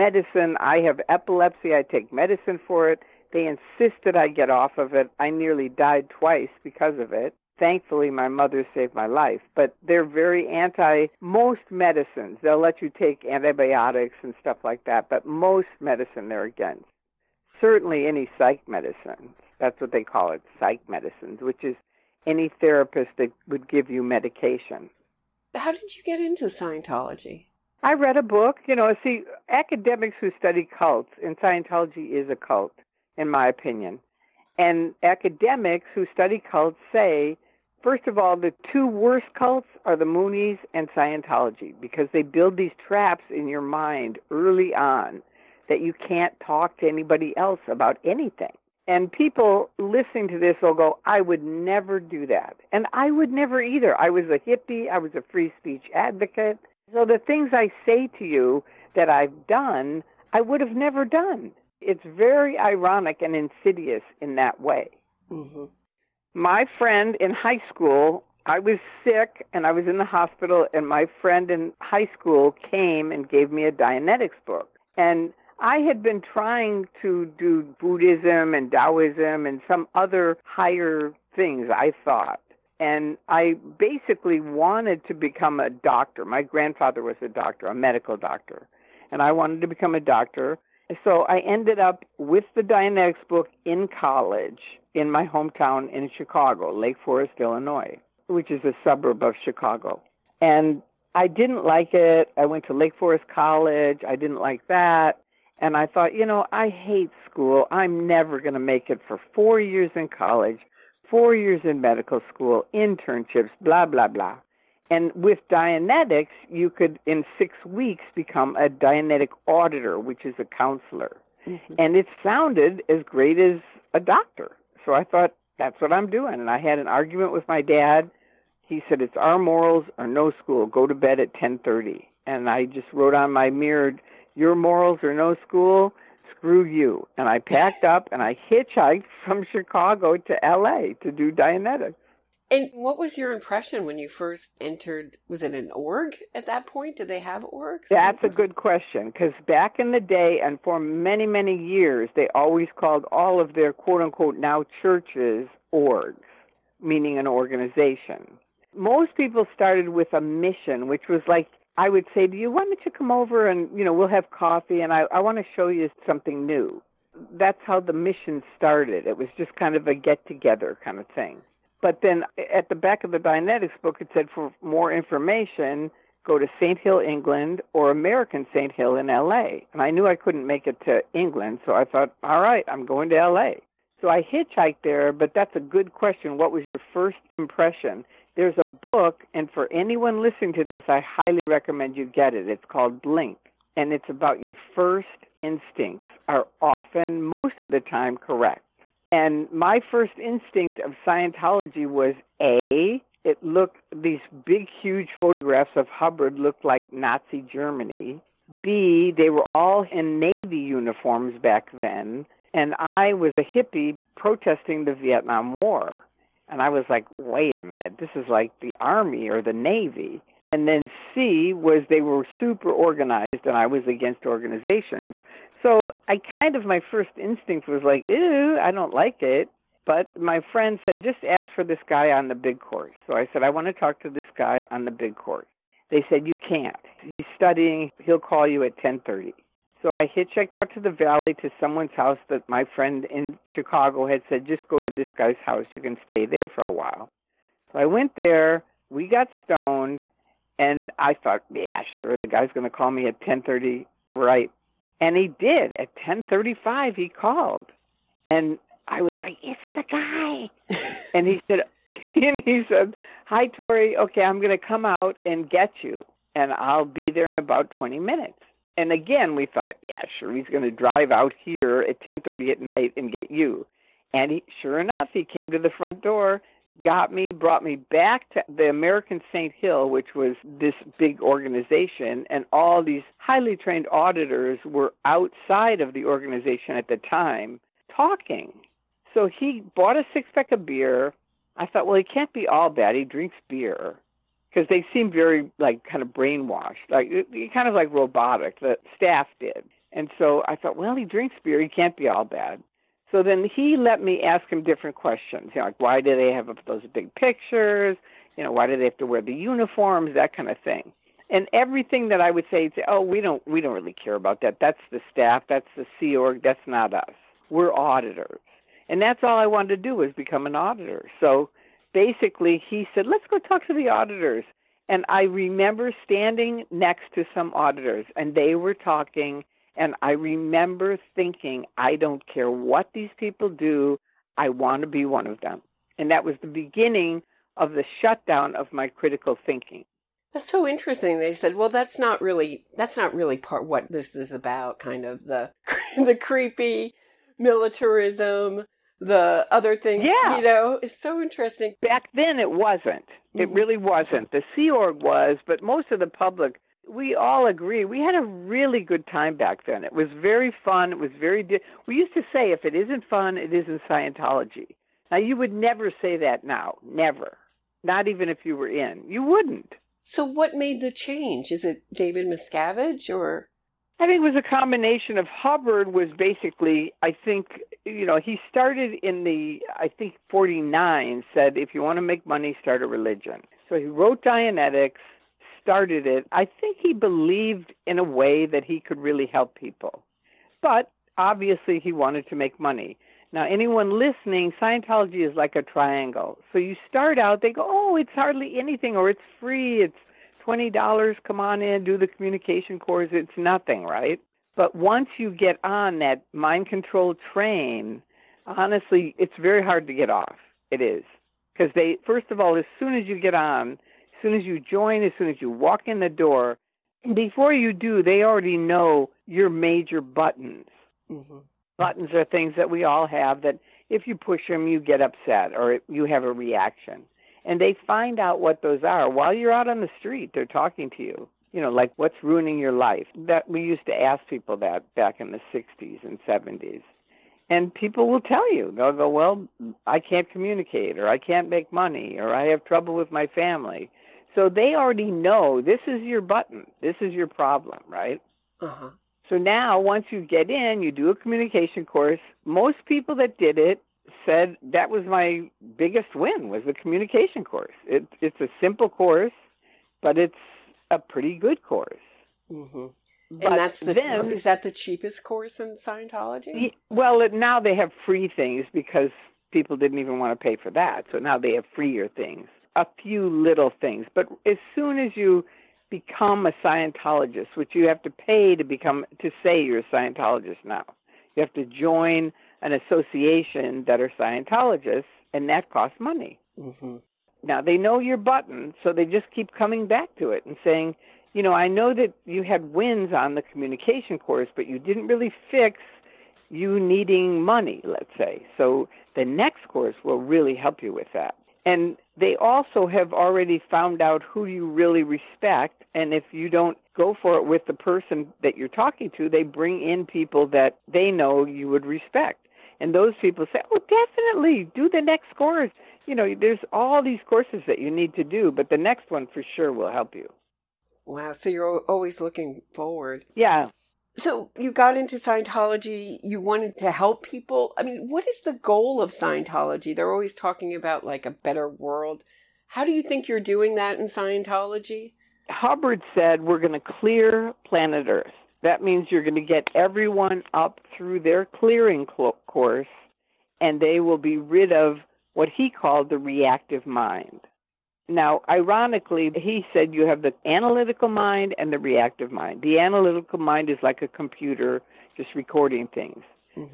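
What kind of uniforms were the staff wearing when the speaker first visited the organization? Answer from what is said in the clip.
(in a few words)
Navy uniforms.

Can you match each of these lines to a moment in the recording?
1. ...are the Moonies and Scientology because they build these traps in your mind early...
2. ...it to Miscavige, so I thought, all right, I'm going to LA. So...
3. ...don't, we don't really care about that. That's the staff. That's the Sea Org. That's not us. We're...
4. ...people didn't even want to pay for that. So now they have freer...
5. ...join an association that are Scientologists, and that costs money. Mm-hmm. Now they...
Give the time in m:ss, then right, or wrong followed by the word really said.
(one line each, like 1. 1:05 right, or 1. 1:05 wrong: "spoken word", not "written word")
1. 0:39 right
2. 3:00 wrong: "England", not "Miscavige"
3. 5:13 right
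4. 7:49 right
5. 8:01 right.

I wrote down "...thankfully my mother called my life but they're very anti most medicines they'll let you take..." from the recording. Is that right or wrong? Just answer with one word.
wrong.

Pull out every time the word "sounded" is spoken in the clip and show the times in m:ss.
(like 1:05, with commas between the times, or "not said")
2:02.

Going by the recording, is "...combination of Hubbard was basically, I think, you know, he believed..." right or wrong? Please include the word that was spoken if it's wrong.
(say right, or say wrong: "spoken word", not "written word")
wrong: "started", not "believed".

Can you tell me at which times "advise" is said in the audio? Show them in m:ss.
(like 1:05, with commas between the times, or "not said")
not said.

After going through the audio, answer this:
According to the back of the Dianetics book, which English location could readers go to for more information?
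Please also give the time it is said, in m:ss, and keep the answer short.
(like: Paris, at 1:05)
St. Hill, England, at 2:56.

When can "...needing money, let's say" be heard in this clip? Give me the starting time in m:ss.
8:16.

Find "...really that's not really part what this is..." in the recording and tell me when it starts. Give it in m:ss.
5:42.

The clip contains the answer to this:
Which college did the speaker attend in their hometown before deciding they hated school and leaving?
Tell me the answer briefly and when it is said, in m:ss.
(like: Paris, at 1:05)
Lake Forest College, at 1:42.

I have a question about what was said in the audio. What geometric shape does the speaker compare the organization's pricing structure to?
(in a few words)
Triangle.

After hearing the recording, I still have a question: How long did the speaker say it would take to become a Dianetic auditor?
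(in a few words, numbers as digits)
6 weeks.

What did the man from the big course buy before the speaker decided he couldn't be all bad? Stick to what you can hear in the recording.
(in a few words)
A six pack of beer.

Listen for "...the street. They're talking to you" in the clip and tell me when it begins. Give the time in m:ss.
7:09.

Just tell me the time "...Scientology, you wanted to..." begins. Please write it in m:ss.
8:45.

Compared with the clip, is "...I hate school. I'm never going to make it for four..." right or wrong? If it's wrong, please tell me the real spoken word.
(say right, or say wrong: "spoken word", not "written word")
right.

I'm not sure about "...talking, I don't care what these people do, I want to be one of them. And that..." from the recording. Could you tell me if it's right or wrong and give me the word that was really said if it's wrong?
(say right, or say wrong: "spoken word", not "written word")
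wrong: "thinking", not "talking".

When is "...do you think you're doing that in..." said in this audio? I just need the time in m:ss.
8:52.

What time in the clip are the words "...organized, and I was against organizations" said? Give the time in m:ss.
3:42.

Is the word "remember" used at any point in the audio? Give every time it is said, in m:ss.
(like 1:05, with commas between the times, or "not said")
5:25, 5:30.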